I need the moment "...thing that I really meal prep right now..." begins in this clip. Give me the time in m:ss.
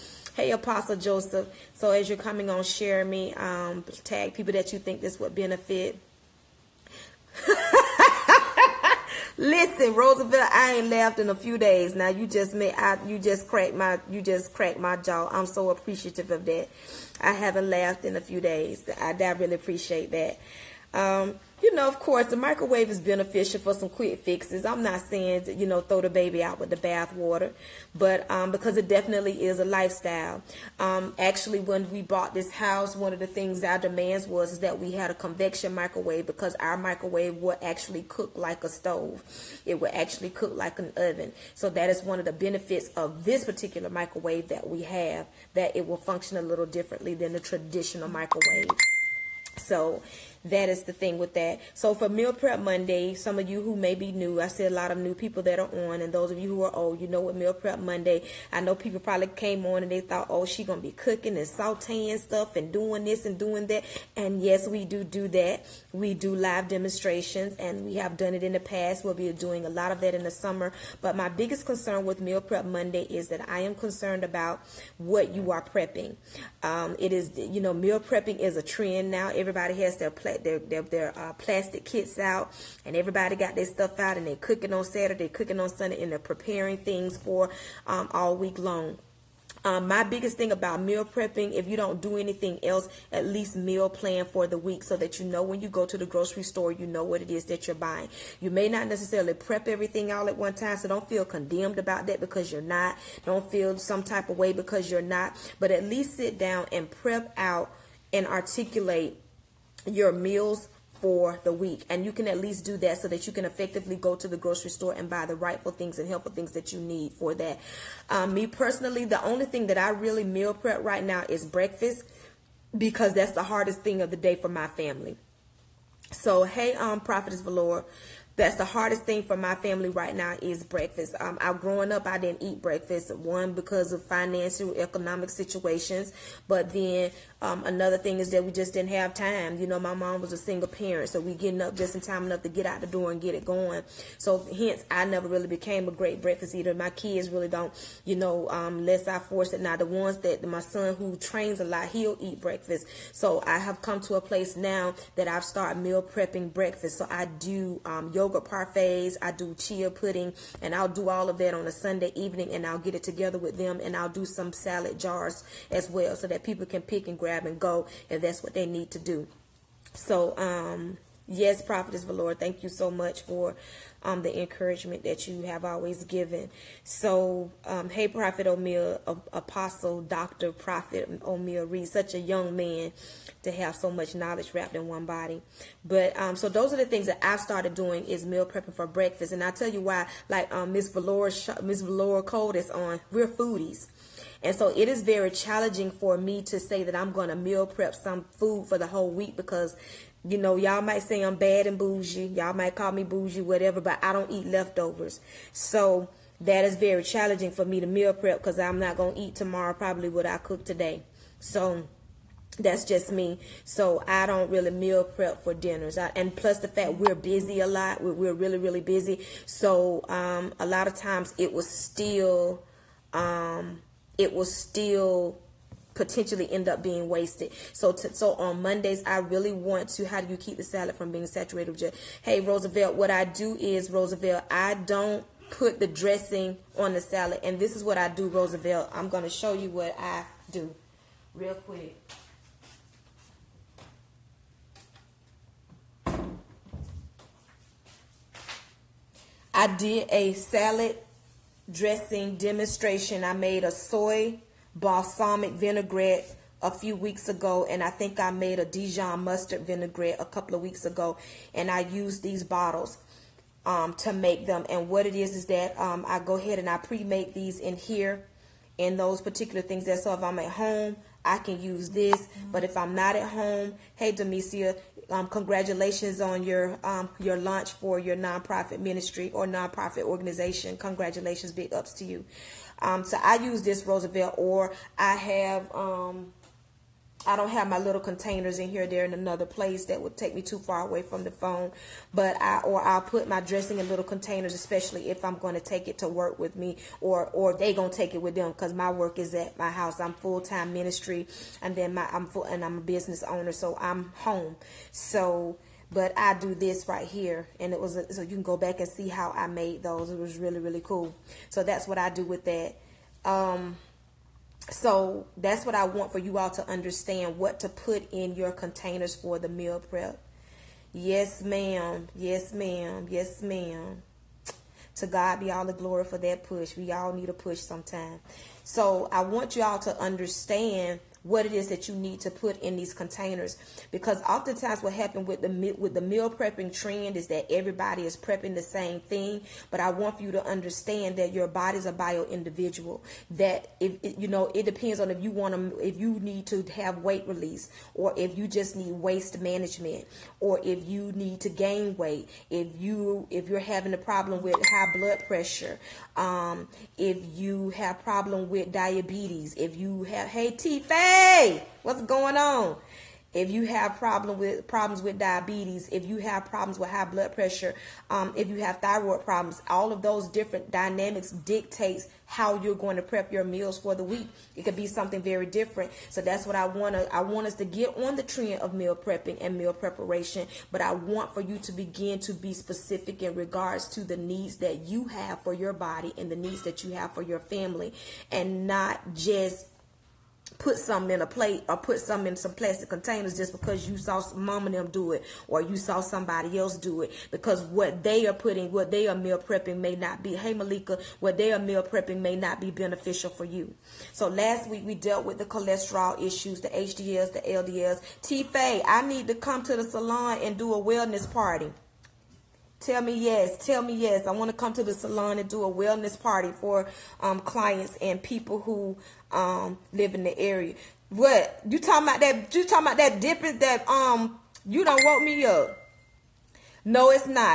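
1:59.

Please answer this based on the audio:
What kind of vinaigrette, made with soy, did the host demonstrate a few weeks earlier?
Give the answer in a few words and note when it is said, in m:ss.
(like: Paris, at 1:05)
Soy balsamic vinaigrette, at 4:13.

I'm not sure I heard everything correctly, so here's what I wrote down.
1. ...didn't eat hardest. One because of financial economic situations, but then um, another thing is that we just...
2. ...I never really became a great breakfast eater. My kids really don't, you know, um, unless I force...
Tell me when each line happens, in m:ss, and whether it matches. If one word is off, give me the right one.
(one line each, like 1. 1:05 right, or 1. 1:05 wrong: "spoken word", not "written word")
1. 2:12 wrong: "breakfast", not "hardest"
2. 2:24 right.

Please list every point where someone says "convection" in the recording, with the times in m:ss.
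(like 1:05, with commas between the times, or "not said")
0:35.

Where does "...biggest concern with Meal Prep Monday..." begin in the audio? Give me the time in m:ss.
1:11.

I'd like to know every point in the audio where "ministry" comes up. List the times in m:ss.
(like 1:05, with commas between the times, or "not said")
4:38, 5:00.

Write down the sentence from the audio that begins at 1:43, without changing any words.
Don't feel some type of way because you're not.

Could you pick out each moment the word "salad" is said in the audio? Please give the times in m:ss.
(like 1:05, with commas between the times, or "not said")
2:44, 3:50, 3:57, 4:10.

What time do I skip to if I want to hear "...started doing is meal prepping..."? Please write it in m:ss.
3:07.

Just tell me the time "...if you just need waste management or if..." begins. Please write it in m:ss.
5:48.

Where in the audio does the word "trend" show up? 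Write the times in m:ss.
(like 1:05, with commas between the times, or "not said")
1:18, 5:36, 6:18.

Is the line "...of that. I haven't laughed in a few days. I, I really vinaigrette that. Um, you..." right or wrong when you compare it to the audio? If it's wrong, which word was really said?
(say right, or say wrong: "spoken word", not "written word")
wrong: "appreciate", not "vinaigrette".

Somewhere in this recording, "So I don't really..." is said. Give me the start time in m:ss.
3:33.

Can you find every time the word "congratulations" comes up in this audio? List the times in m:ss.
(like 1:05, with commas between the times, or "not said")
4:35, 4:40.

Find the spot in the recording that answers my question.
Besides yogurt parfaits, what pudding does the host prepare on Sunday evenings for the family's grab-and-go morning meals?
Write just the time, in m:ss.
2:39.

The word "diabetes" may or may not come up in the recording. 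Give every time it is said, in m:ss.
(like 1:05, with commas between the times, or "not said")
5:58, 6:05.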